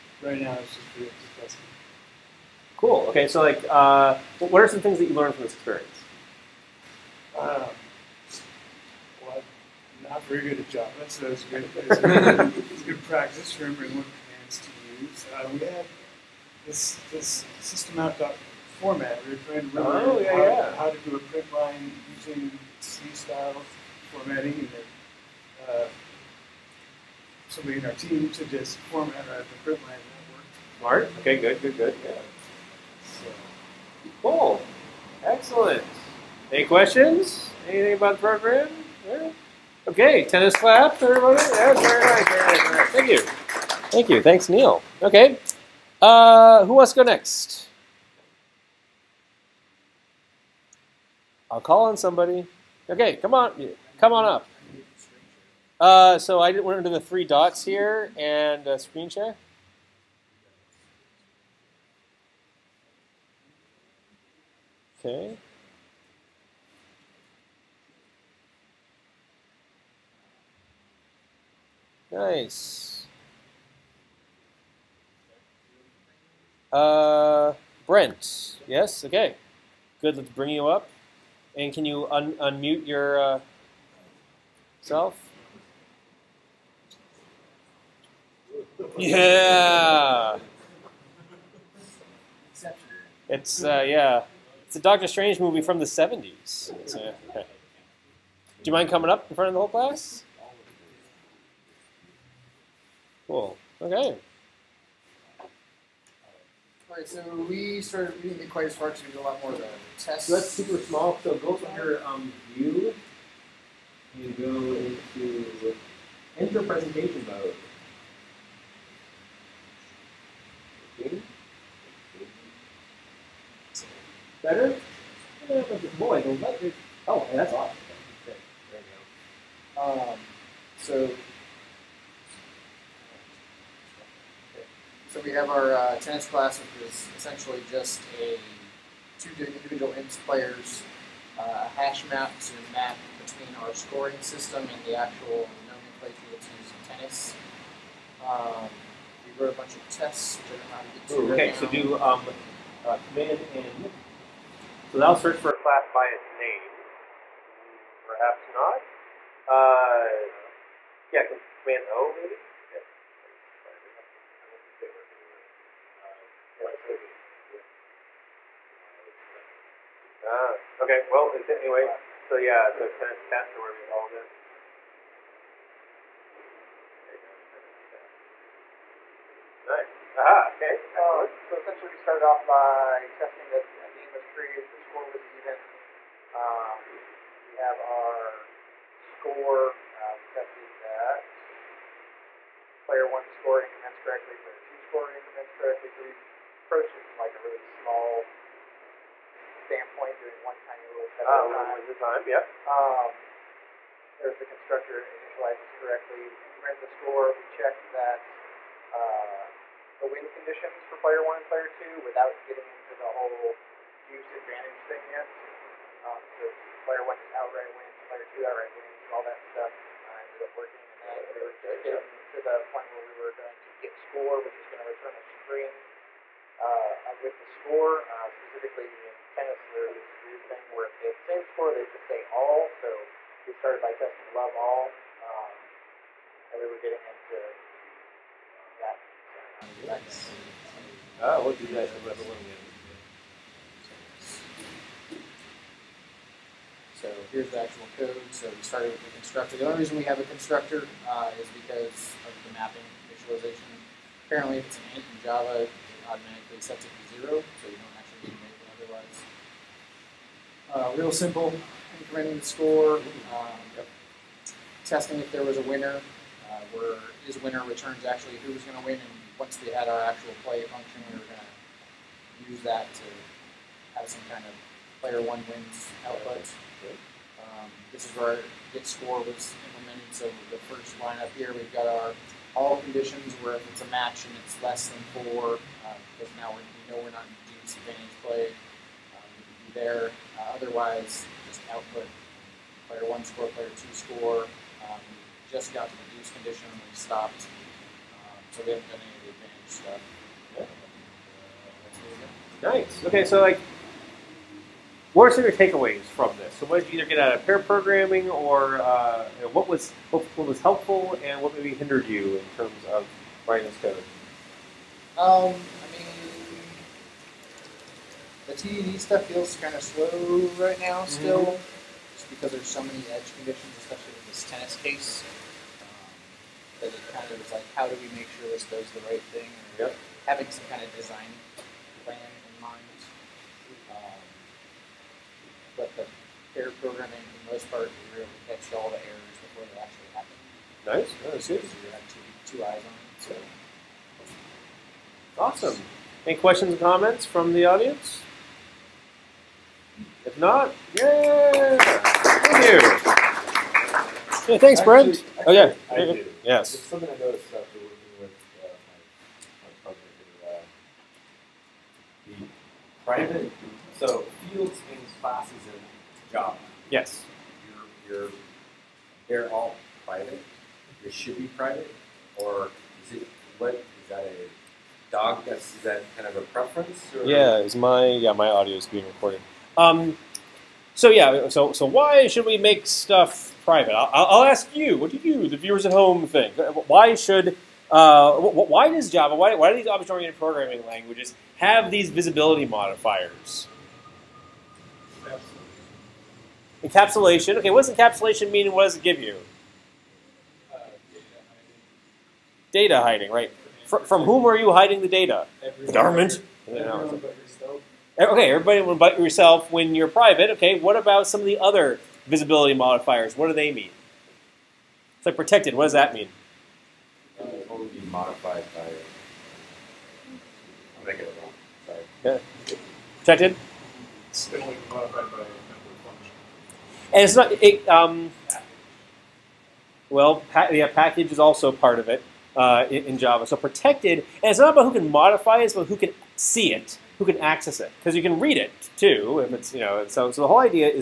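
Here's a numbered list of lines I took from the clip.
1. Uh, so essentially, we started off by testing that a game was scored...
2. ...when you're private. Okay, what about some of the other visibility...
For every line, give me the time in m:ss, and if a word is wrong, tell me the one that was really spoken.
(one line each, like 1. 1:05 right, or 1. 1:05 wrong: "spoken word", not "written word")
1. 3:00 wrong: "created", not "scored"
2. 6:49 right.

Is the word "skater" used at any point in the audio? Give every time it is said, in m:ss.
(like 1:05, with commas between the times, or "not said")
not said.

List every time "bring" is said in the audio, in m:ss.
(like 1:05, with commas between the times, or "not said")
1:20.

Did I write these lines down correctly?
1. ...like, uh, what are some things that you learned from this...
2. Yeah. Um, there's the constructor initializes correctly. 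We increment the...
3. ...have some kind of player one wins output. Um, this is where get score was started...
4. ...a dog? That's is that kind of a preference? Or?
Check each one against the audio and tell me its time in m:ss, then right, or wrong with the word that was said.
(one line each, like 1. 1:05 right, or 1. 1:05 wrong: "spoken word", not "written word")
1. 0:03 right
2. 3:22 right
3. 4:33 wrong: "implemented", not "started"
4. 6:14 right.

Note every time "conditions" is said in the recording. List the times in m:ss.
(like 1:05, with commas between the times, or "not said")
3:30, 4:42, 4:56, 5:23.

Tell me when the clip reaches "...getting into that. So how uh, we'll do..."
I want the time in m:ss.
3:56.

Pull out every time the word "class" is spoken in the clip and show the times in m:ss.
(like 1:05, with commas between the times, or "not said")
1:39, 2:16, 2:35.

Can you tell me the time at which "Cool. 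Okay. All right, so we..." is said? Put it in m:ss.
1:43.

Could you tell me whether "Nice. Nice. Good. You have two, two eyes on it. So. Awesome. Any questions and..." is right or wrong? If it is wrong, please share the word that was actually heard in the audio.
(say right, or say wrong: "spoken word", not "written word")
right.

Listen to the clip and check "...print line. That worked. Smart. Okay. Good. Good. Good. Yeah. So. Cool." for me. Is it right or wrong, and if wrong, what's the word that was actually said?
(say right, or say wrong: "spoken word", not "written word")
right.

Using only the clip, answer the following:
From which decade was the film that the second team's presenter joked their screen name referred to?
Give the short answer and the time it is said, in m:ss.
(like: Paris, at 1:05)
the '70s, at 1:35.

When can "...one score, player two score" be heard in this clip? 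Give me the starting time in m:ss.
4:53.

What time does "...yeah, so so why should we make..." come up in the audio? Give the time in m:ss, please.
6:21.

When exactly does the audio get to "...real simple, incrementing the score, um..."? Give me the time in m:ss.
4:20.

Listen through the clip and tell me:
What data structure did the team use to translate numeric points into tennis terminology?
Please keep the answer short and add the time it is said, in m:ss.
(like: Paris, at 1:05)
hash map, at 2:21.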